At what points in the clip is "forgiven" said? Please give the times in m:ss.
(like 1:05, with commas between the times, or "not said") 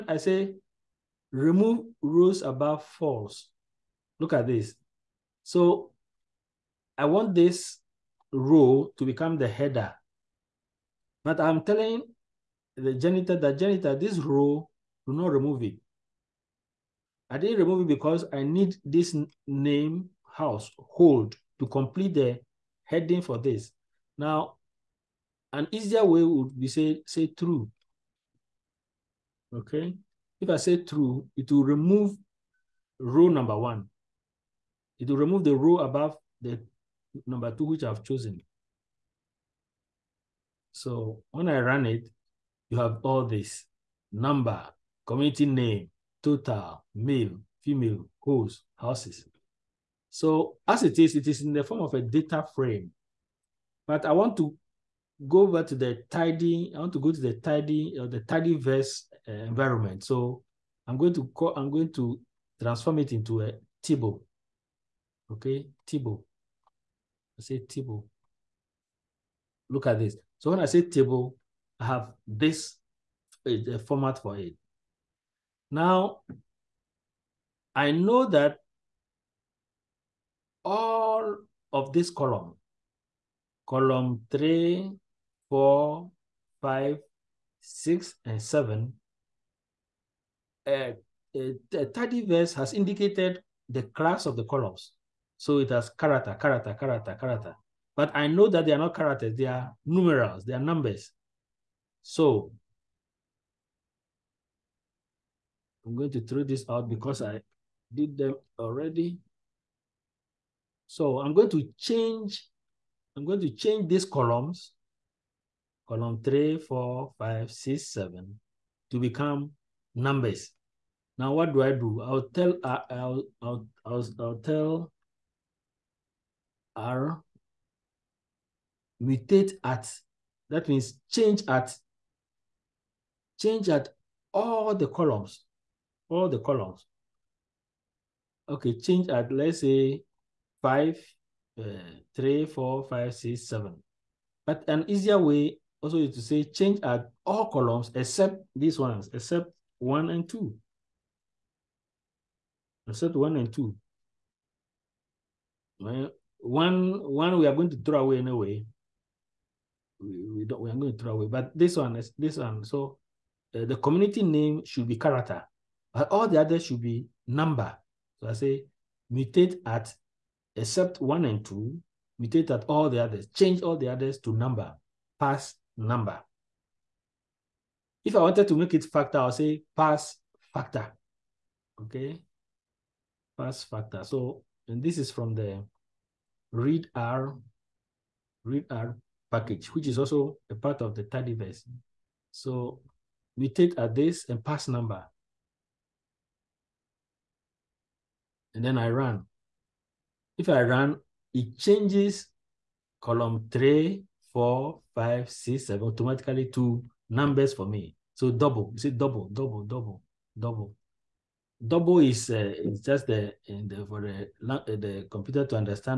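not said.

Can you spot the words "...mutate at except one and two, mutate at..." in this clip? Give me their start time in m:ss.
2:49.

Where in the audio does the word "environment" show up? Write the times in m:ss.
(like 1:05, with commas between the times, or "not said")
0:59.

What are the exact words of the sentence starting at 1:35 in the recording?
So it has character, character, character, character.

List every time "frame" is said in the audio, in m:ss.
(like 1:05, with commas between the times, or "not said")
0:52.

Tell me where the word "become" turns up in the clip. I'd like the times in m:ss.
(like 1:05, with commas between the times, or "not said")
0:09, 1:58.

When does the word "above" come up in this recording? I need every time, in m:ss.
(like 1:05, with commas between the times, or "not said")
0:02, 0:35.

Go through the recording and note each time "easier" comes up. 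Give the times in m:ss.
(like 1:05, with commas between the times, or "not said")
0:25, 2:24.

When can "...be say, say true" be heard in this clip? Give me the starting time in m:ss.
0:26.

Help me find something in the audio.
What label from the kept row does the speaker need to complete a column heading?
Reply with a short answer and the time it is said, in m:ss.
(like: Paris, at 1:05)
house hold, at 0:20.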